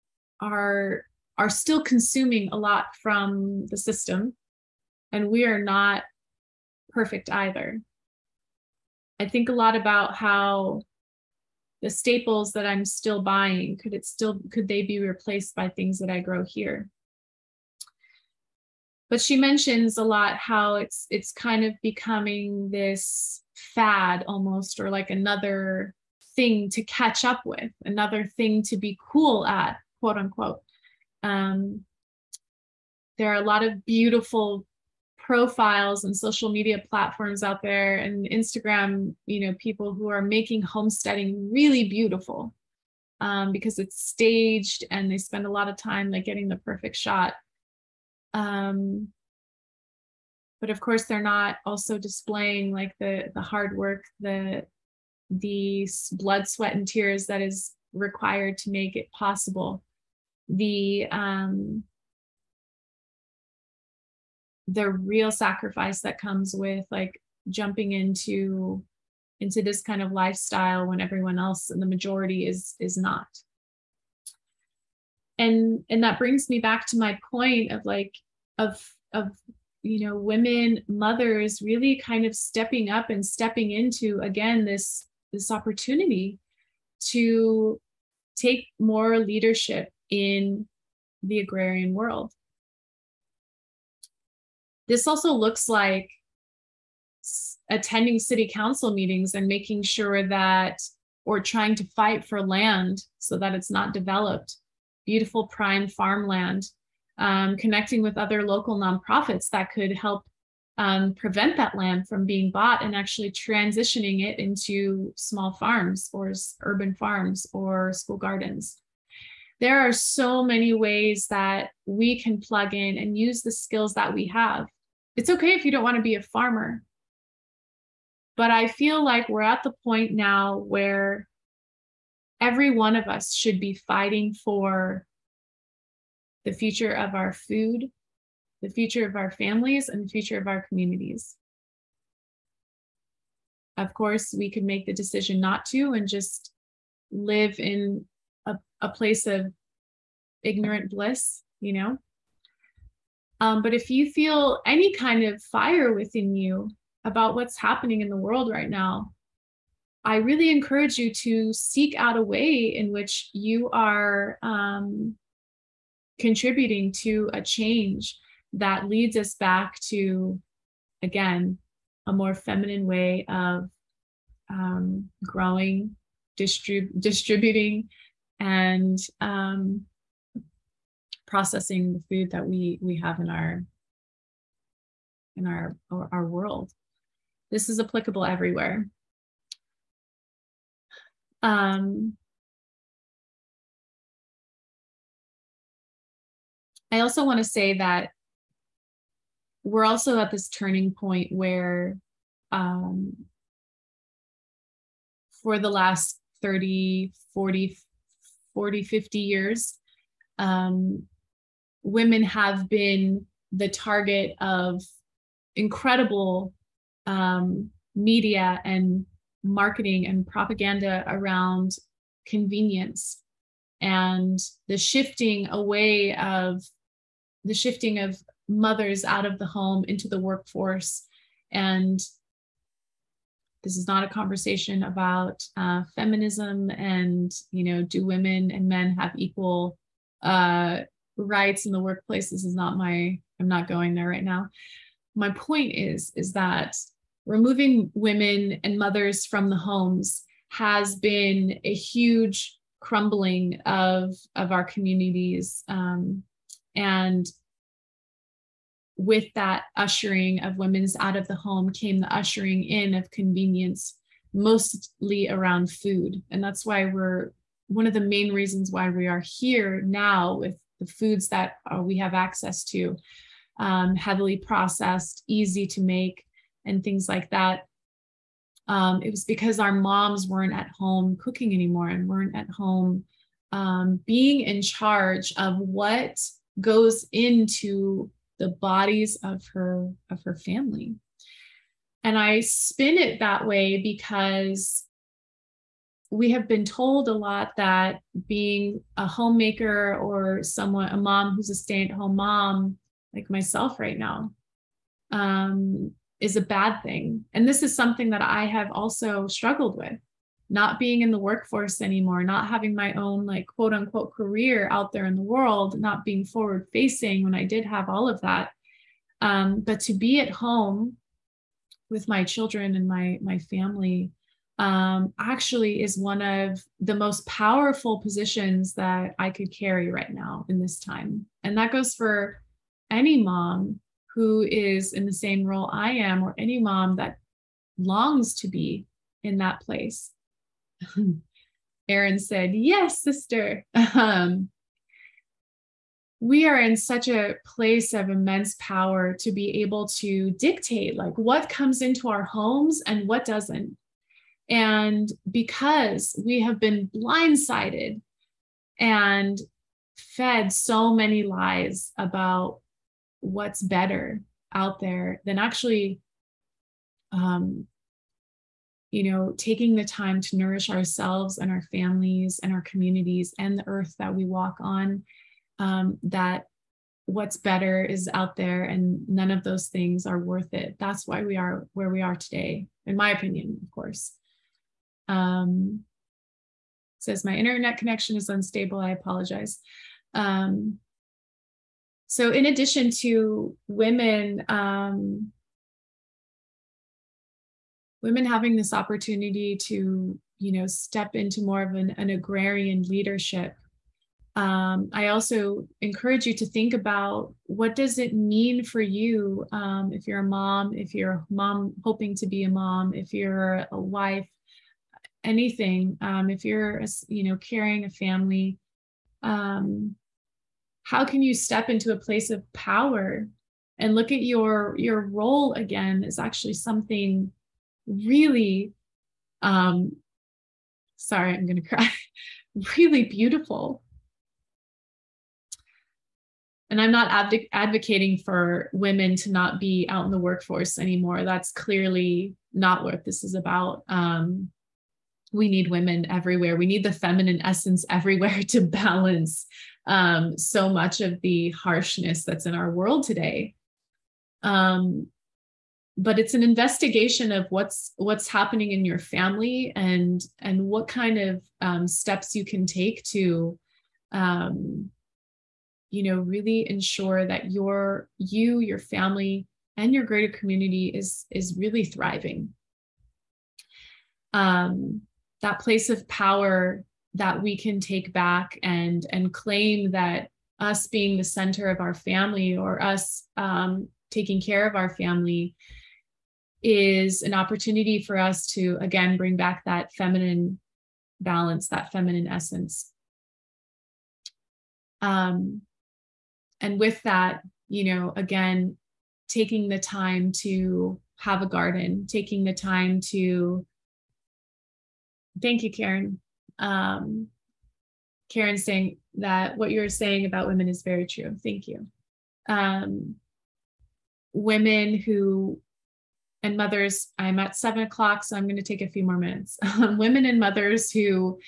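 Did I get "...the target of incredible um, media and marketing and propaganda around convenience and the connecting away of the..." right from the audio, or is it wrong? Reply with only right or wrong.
wrong.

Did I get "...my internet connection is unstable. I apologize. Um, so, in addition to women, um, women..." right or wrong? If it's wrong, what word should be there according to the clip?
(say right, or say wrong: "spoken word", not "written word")
right.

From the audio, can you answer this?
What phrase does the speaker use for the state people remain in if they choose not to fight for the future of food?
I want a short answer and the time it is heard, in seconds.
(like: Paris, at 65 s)
Ignorant bliss, at 150 s.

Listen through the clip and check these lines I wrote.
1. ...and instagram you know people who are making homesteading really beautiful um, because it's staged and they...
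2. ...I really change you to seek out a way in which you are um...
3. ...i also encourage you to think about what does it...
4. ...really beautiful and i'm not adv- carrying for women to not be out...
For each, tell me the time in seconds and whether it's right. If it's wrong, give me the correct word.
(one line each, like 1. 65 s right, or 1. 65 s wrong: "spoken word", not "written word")
1. 37 s right
2. 160 s wrong: "encourage", not "change"
3. 404 s right
4. 432 s wrong: "advocating", not "carrying".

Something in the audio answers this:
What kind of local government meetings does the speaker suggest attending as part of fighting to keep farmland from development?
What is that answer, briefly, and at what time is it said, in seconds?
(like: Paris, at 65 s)
City council meetings, at 98 s.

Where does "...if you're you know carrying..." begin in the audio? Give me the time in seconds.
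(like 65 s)
416 s.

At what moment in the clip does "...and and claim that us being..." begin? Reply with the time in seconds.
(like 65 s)
478 s.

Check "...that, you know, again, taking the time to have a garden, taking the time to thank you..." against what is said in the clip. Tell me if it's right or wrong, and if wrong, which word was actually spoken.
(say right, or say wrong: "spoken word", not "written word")
right.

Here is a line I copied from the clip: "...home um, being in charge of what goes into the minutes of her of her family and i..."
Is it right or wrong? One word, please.
wrong.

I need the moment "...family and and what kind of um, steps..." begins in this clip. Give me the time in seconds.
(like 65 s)
458 s.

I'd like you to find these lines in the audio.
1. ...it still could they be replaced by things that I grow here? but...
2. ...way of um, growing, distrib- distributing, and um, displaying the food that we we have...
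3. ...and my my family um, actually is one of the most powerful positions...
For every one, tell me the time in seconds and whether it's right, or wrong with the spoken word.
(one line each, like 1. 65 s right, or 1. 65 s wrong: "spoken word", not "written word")
1. 13 s right
2. 172 s wrong: "processing", not "displaying"
3. 322 s right.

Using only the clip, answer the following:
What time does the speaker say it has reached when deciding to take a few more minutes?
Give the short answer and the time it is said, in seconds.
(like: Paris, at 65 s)
7 o'clock, at 517 s.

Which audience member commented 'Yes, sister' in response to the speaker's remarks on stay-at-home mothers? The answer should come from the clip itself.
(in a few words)
Aaron.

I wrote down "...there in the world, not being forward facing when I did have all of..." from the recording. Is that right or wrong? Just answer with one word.
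right.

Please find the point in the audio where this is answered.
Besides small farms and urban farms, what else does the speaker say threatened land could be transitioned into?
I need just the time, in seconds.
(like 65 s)
117 s.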